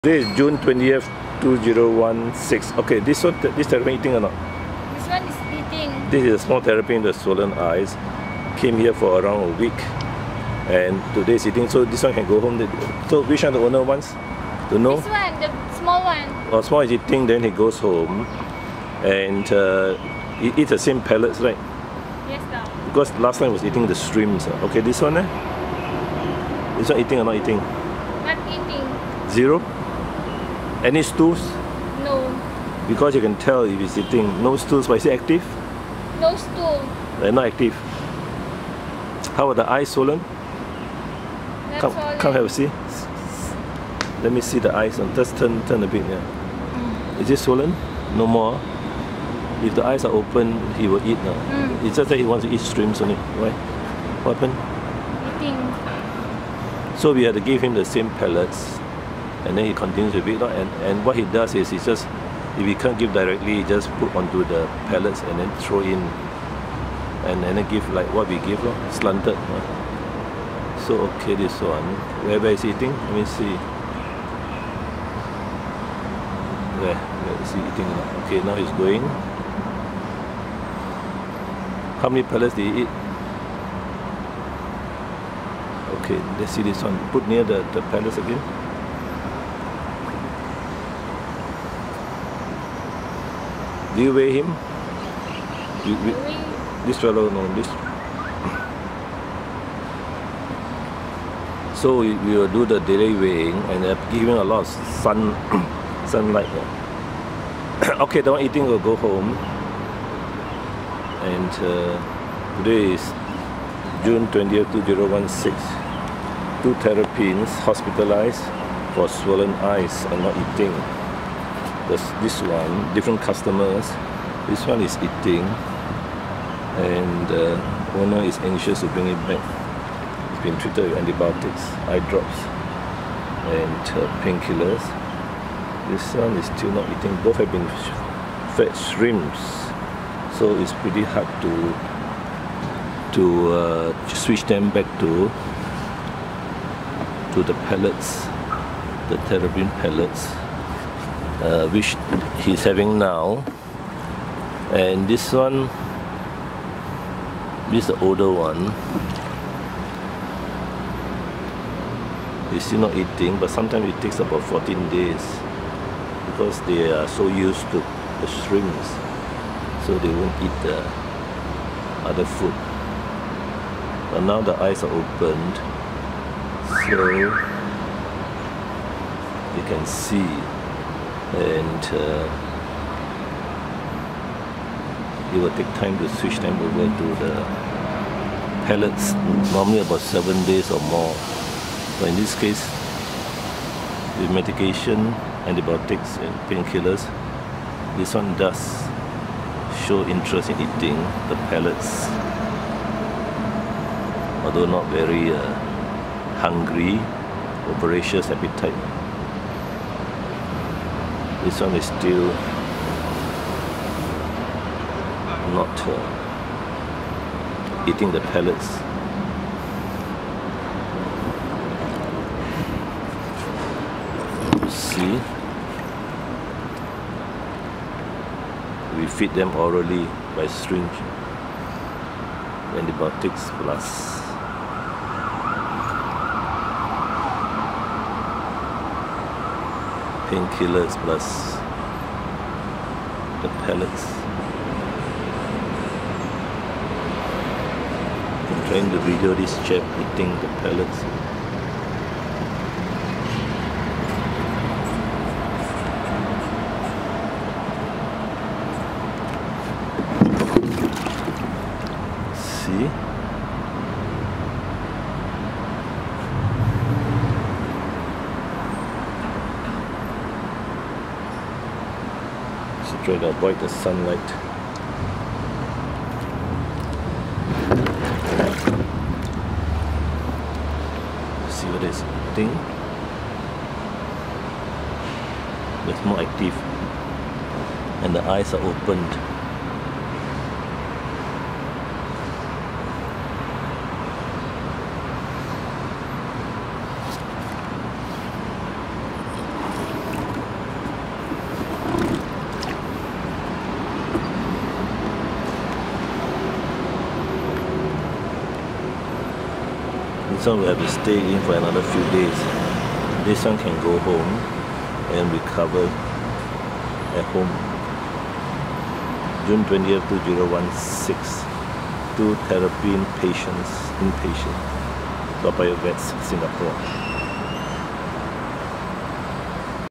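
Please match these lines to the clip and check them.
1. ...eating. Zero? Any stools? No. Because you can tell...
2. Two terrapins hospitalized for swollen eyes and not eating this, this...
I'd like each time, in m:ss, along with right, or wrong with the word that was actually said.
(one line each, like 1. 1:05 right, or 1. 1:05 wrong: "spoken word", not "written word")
1. 0:28 right
2. 1:56 right.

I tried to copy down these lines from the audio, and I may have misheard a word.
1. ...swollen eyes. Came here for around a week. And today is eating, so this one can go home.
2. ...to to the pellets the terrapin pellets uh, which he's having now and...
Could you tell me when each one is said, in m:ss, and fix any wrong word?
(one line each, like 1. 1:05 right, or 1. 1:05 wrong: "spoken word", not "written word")
1. 0:07 right
2. 2:24 right.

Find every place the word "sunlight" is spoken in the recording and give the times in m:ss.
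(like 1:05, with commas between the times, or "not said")
1:46, 4:33.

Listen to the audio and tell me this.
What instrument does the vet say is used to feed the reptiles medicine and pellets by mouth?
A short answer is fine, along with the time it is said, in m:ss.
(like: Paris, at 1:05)
Syringe, at 3:50.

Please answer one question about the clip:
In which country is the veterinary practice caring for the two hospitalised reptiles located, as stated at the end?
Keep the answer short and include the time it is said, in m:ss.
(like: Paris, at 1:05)
Singapore, at 5:26.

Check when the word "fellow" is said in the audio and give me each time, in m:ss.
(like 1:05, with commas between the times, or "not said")
1:36.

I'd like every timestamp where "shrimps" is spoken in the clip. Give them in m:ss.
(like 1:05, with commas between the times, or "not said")
0:23, 0:52, 2:18, 2:48.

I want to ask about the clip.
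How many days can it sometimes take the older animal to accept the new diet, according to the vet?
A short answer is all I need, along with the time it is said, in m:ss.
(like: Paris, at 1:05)
14 days, at 2:44.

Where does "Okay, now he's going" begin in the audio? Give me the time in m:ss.
1:18.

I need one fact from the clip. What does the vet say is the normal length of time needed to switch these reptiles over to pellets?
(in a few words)
7 days or more.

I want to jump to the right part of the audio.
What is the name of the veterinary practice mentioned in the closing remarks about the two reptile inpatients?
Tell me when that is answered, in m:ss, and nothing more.
5:25.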